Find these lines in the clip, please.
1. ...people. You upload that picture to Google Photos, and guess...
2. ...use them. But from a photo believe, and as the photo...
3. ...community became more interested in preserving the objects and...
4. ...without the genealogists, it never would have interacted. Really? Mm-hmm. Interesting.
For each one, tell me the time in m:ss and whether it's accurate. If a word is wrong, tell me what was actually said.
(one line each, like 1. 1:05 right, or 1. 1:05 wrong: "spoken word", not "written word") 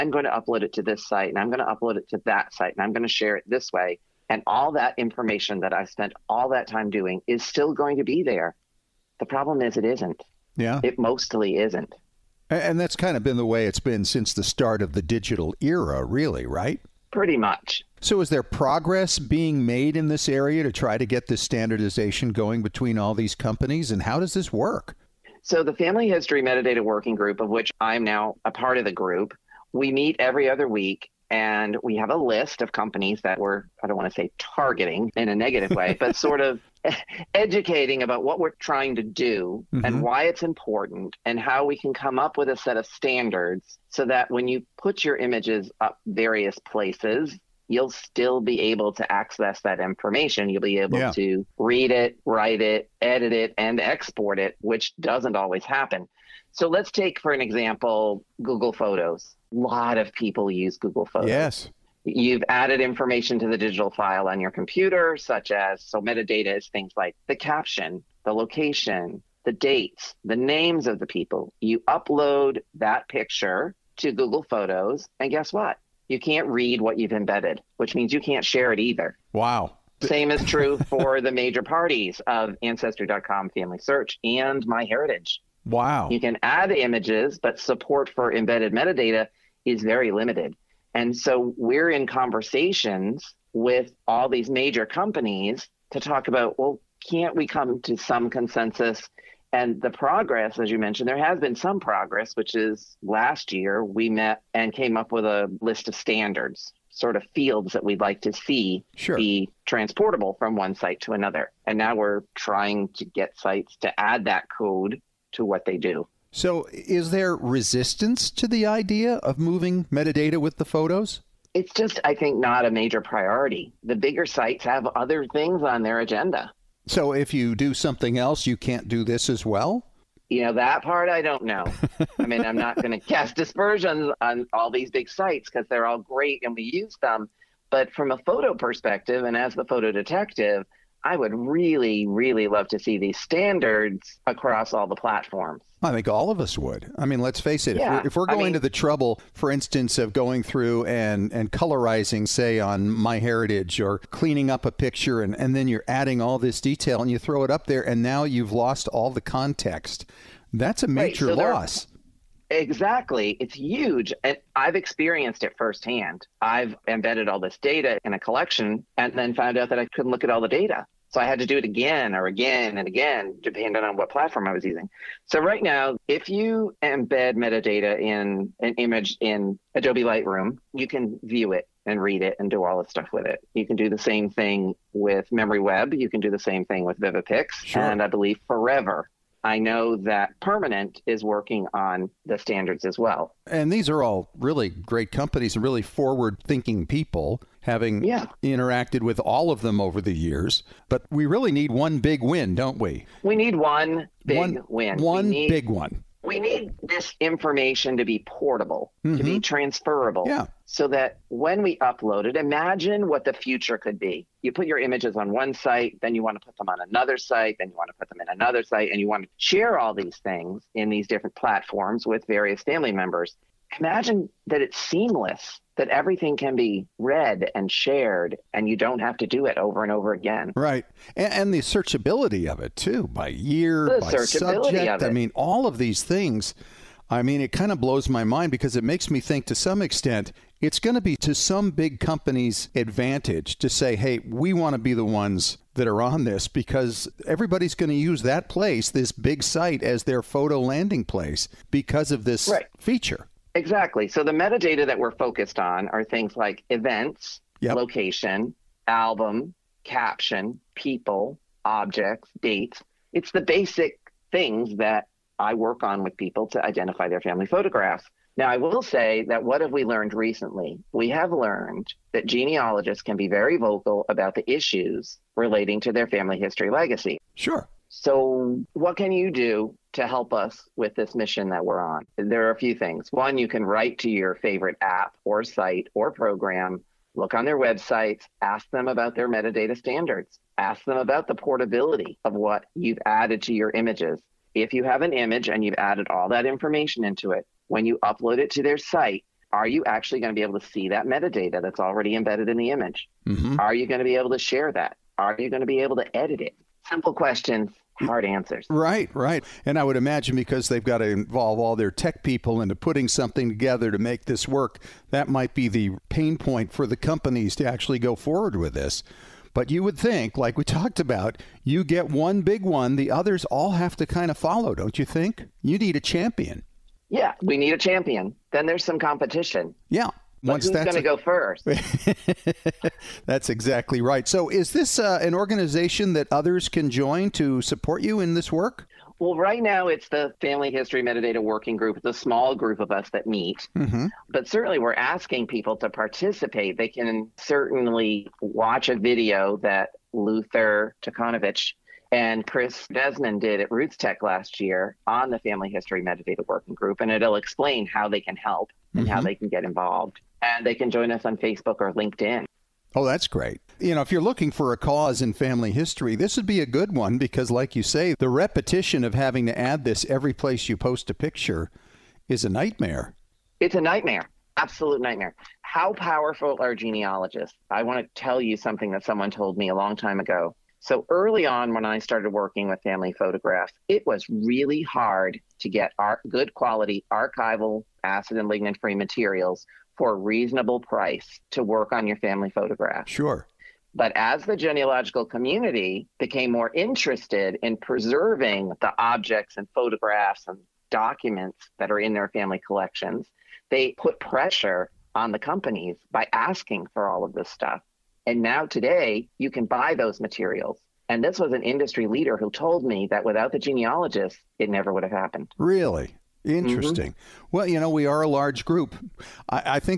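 1. 1:11 right
2. 2:16 wrong: "perspective", not "believe"
3. 6:35 right
4. 6:53 wrong: "happened", not "interacted".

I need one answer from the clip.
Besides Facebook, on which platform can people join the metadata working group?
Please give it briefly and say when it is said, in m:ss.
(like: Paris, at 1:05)
LinkedIn, at 6:01.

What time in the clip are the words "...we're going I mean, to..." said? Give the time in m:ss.
2:28.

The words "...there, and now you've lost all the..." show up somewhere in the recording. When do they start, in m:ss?
2:37.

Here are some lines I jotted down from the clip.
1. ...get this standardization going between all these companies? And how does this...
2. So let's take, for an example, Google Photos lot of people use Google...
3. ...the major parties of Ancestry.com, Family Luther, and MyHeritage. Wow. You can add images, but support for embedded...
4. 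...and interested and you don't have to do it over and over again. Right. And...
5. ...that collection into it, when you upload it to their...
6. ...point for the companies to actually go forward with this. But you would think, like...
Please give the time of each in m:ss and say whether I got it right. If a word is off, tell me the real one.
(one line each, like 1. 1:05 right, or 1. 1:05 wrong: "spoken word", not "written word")
1. 0:21 right
2. 0:56 right
3. 1:21 wrong: "Search", not "Luther"
4. 3:47 wrong: "shared", not "interested"
5. 4:56 wrong: "information", not "collection"
6. 5:16 right.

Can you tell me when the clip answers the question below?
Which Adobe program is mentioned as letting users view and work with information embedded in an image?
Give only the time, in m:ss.
2:59.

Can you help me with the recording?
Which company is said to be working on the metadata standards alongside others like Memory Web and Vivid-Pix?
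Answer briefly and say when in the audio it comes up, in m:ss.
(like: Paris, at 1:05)
Permanent, at 3:10.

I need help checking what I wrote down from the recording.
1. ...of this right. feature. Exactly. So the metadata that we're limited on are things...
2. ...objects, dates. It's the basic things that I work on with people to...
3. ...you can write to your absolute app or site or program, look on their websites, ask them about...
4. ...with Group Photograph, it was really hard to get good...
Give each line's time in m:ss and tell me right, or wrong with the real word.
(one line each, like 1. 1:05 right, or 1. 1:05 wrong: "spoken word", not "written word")
1. 4:12 wrong: "focused", not "limited"
2. 4:21 right
3. 4:43 wrong: "favorite", not "absolute"
4. 6:22 wrong: "Family", not "Group".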